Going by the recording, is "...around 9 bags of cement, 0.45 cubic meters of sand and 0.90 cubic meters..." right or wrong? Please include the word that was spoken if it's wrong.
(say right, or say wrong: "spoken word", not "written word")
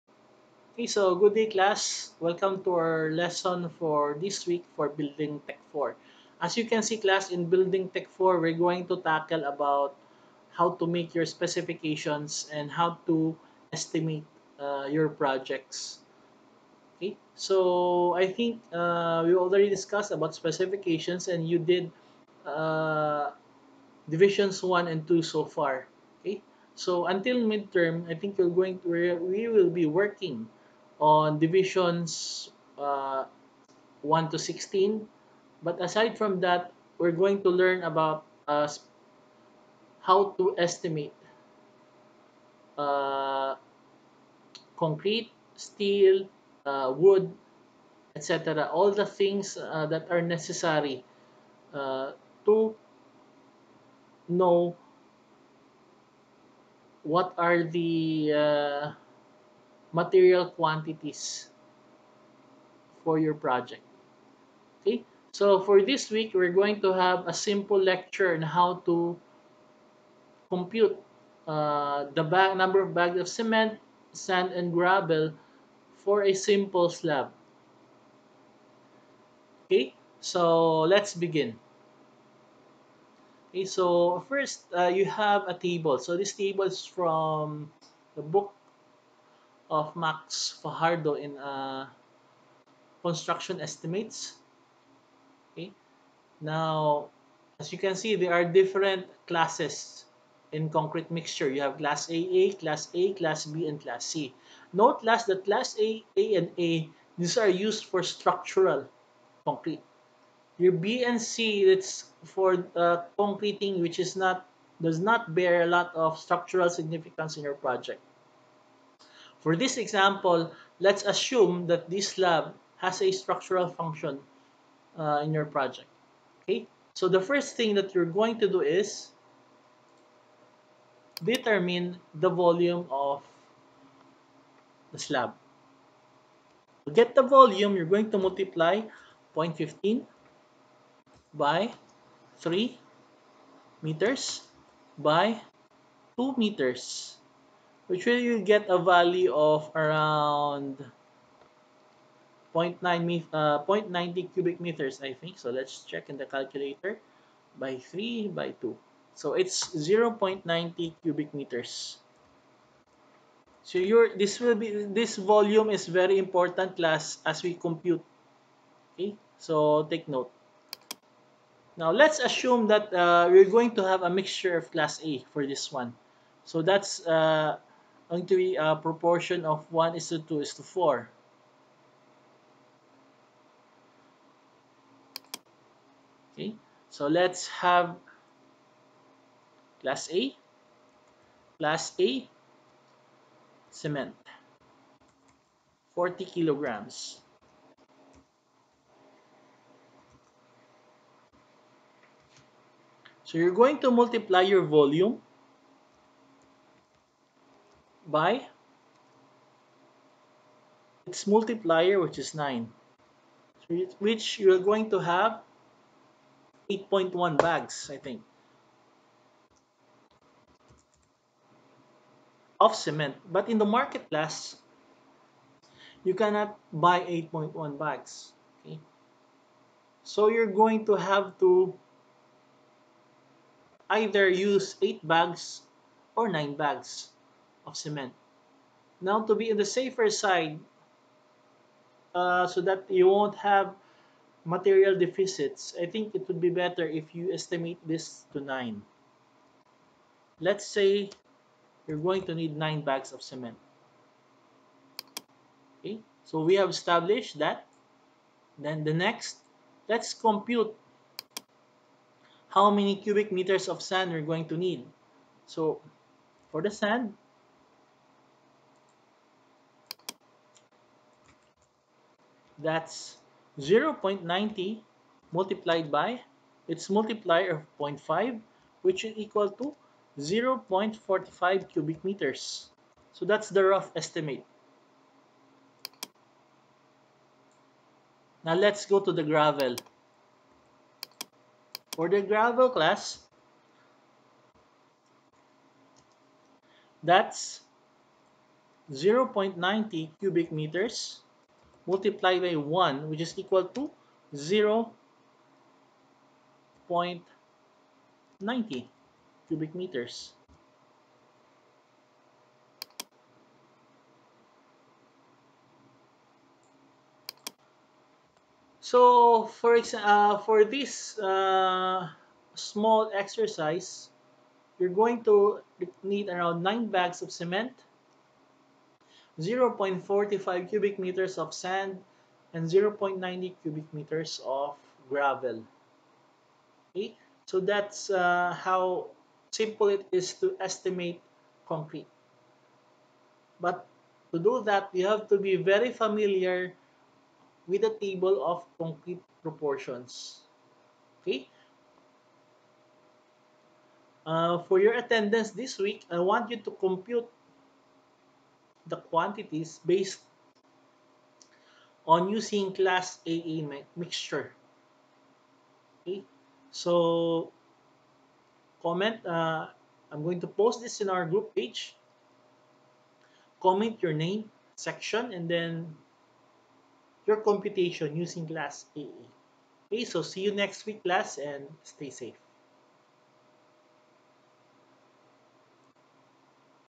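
right.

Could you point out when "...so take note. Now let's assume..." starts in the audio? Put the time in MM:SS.
02:49.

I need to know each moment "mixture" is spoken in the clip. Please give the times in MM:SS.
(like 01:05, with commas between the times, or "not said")
01:41, 02:54, 06:03.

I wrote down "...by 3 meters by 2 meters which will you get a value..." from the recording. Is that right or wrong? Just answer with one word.
right.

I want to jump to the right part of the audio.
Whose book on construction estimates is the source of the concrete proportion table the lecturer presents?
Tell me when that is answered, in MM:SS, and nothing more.
01:29.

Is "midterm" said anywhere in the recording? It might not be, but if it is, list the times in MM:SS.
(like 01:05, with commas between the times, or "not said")
00:27.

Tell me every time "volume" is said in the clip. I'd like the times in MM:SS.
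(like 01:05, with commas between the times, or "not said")
02:12, 02:17, 02:45, 03:24.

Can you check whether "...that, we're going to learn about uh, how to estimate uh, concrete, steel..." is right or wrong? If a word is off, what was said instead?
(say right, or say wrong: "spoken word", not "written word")
right.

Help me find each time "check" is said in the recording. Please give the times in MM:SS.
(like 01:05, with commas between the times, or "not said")
02:35.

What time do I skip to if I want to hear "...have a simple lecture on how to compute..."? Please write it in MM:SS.
01:06.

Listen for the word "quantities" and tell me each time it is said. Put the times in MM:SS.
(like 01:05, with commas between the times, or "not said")
01:00, 05:58.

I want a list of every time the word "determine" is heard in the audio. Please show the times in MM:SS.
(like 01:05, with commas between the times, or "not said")
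02:11.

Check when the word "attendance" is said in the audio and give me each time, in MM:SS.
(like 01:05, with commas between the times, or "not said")
05:54.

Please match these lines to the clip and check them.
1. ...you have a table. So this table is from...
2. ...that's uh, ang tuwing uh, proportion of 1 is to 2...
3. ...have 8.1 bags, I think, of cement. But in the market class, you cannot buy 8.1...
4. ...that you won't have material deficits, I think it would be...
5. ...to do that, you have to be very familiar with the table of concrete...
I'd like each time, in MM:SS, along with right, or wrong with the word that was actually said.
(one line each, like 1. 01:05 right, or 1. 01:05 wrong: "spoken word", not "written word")
1. 01:24 right
2. 02:56 right
3. 03:34 right
4. 04:02 right
5. 05:44 right.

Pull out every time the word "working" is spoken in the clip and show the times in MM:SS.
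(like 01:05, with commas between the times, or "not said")
00:29.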